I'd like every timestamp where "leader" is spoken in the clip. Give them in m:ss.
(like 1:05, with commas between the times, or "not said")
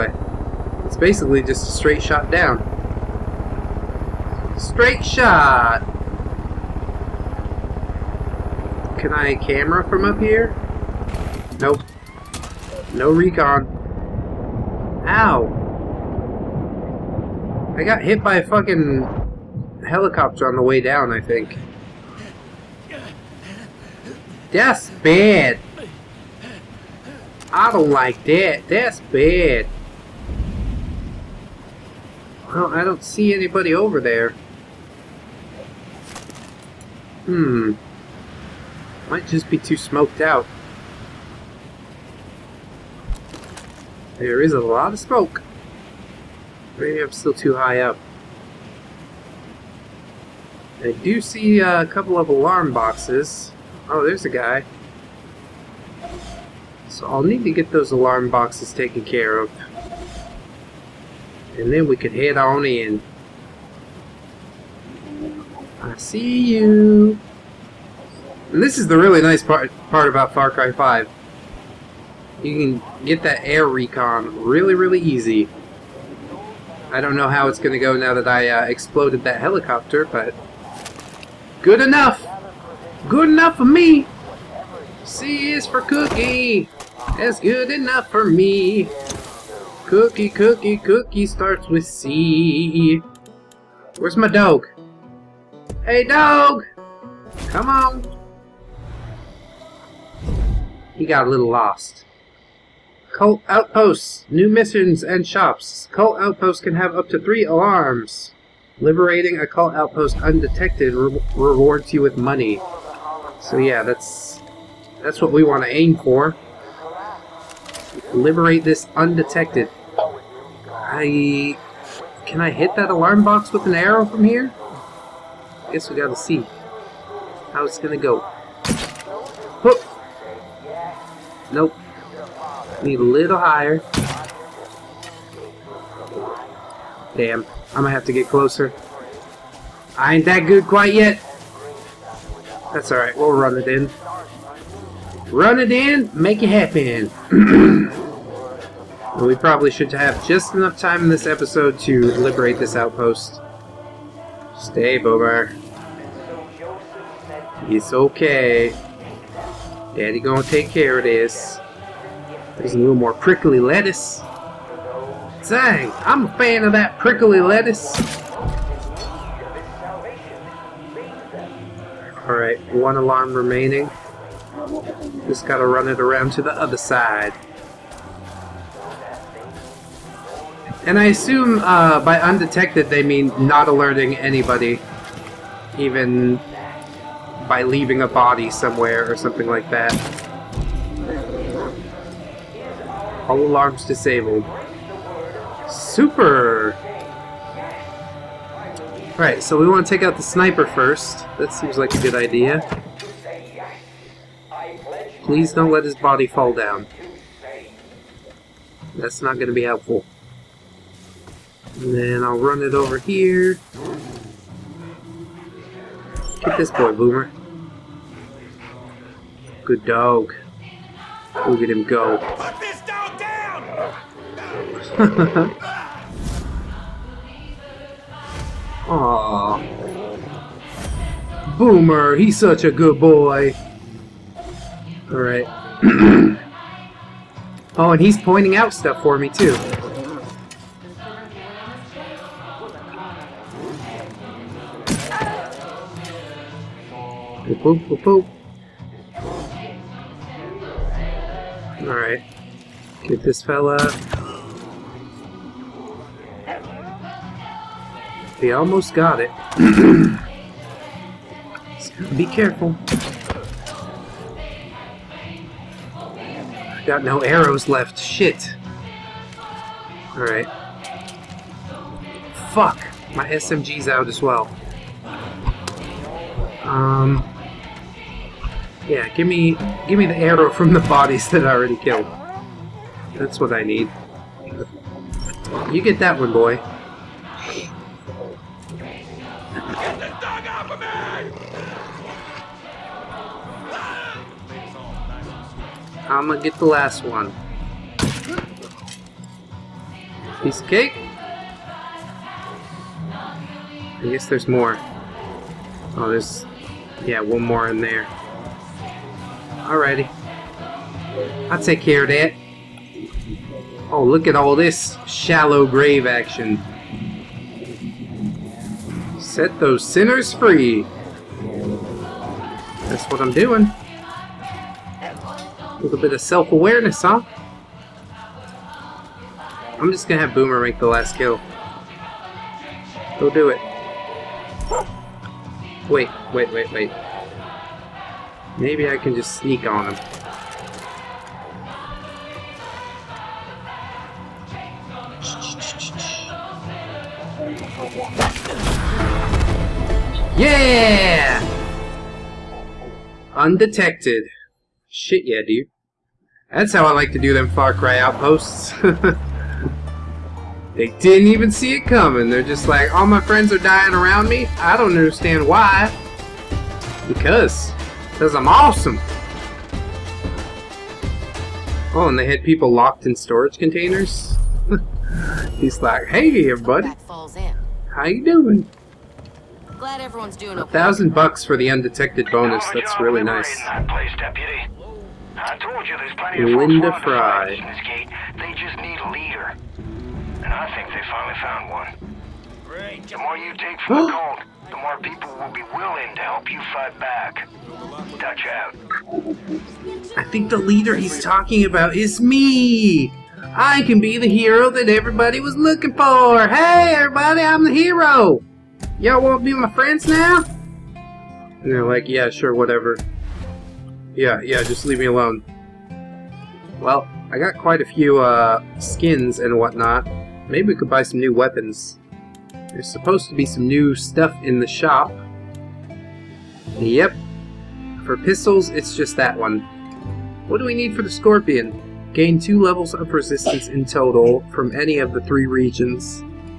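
6:29, 6:40.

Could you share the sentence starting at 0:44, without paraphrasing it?
There is a lot of smoke.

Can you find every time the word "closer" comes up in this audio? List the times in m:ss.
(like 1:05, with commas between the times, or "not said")
2:18.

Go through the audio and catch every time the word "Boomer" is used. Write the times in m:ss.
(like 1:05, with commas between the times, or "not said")
2:34, 3:36, 3:51, 5:30.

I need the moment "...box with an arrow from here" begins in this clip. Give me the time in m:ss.
2:03.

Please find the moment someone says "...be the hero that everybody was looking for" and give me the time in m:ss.
6:43.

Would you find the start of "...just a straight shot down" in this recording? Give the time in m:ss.
0:01.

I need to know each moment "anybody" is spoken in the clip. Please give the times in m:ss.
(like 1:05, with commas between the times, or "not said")
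0:33, 3:04.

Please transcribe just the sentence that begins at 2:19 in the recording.
I ain't that good quite yet.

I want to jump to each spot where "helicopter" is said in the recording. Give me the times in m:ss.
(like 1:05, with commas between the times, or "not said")
0:19, 1:19.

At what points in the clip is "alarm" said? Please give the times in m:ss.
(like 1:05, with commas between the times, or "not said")
0:52, 0:57, 1:47, 2:02, 2:52, 3:13.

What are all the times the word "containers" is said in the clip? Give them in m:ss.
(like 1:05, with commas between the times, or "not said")
6:13.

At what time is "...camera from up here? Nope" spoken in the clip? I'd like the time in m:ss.
0:09.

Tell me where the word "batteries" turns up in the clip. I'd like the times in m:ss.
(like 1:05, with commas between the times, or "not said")
not said.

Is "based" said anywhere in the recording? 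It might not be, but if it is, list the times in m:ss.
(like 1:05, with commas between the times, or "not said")
not said.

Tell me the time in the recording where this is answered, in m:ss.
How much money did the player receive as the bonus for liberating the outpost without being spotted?
6:20.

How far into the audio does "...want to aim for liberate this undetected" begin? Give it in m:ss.
1:55.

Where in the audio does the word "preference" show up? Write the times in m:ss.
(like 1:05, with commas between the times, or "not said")
not said.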